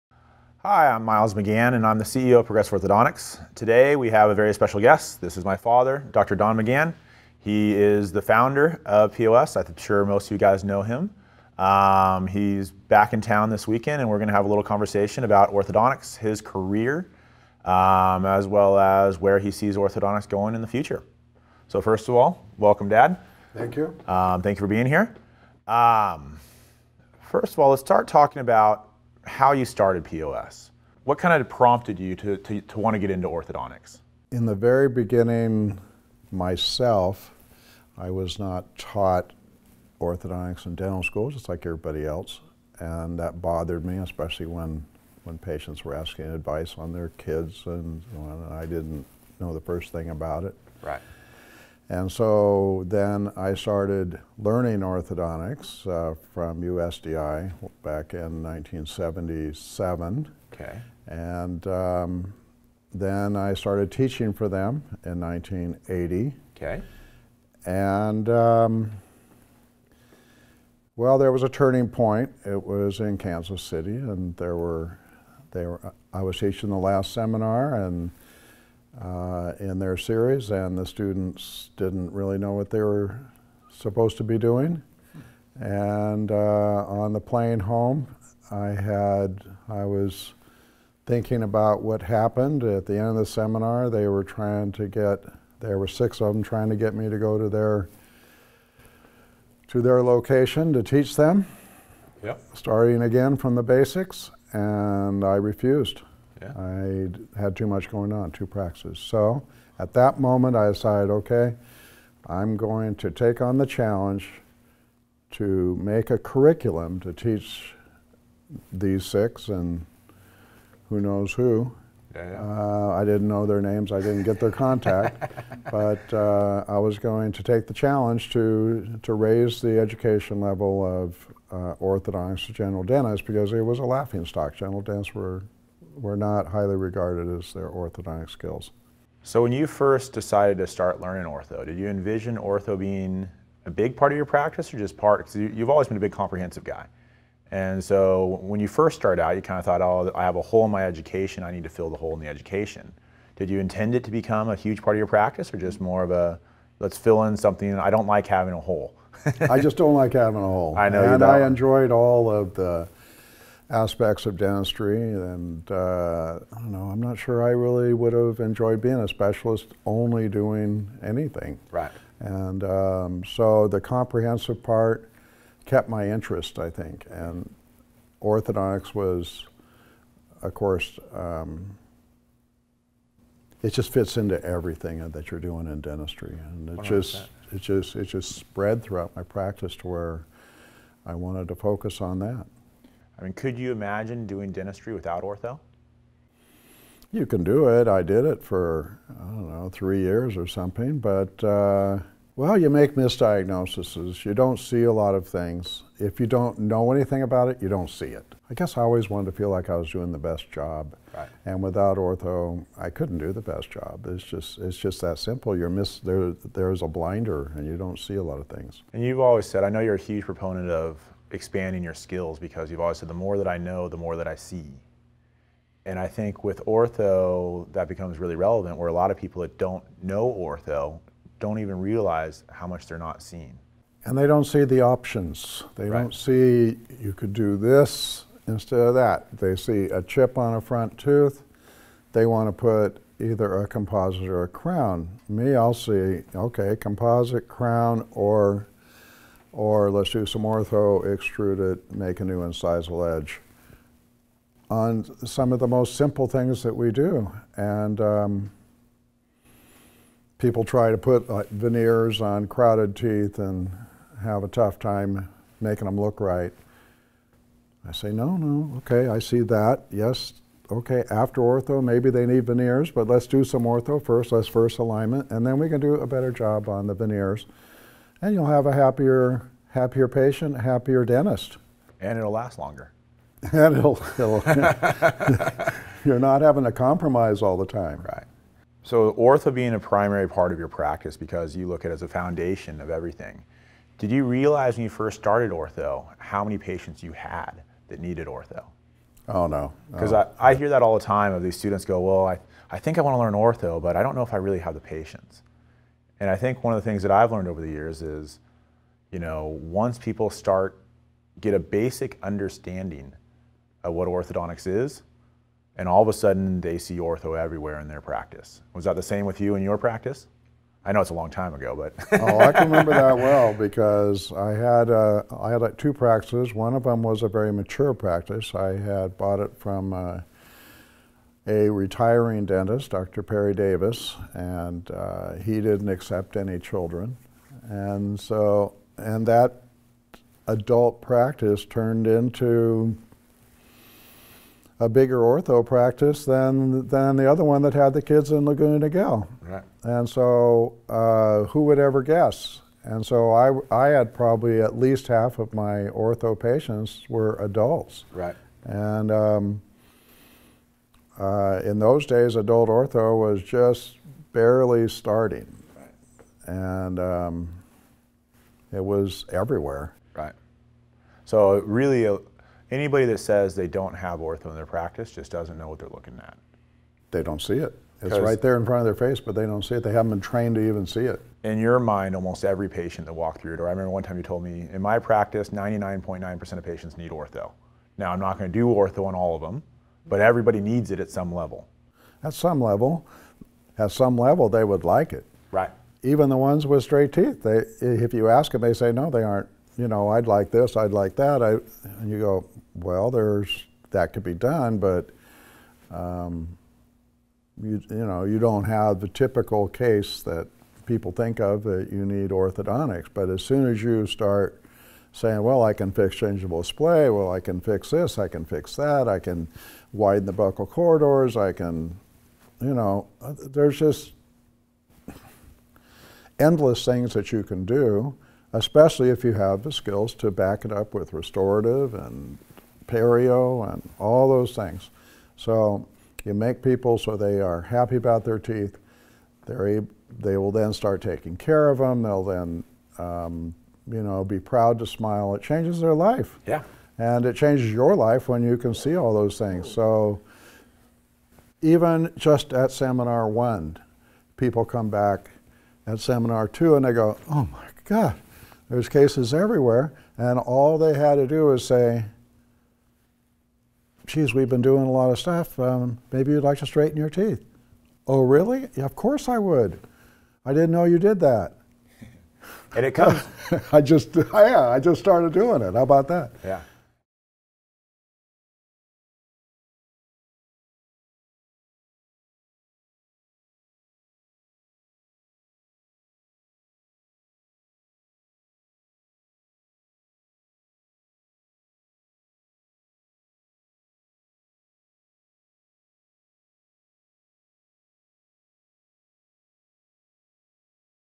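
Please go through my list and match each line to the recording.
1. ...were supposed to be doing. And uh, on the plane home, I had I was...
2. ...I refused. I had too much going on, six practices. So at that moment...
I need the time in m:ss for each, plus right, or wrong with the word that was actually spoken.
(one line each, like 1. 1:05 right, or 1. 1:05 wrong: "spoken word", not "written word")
1. 1:22 right
2. 1:45 wrong: "two", not "six".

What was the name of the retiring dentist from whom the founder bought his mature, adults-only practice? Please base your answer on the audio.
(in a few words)
Dr. Perry Davis.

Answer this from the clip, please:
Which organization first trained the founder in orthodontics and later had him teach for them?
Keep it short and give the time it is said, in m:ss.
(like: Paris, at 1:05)
USDI, at 0:56.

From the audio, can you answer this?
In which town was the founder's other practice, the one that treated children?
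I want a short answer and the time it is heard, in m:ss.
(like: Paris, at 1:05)
Laguna Niguel, at 5:48.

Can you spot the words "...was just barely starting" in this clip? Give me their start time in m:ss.
6:03.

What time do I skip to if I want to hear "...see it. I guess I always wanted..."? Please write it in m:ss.
3:27.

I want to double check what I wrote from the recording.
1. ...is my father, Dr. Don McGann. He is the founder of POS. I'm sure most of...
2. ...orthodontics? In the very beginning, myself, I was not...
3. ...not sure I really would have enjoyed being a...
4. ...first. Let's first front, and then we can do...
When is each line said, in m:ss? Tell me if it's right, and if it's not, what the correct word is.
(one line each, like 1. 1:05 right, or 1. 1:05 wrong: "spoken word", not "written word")
1. 0:05 right
2. 0:33 right
3. 2:47 right
4. 4:34 wrong: "alignment", not "front".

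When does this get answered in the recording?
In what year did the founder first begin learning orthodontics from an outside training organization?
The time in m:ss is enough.
0:58.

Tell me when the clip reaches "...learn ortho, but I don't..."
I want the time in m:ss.
5:03.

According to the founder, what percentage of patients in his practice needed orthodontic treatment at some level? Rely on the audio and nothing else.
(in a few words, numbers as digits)
99.9%.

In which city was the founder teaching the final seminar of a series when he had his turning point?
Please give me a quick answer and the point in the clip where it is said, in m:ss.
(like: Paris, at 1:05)
Kansas City, at 1:13.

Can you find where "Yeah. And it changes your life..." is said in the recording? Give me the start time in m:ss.
7:26.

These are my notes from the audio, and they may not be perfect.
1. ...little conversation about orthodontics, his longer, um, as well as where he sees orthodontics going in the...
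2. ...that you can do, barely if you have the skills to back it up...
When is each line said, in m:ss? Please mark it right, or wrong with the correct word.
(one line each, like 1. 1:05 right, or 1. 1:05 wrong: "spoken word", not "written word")
1. 0:14 wrong: "career", not "longer"
2. 7:07 wrong: "especially", not "barely".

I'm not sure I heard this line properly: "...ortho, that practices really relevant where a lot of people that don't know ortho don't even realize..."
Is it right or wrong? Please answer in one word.
wrong.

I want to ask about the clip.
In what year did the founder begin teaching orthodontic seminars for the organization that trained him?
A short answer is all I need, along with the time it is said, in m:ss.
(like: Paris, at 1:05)
1980, at 1:05.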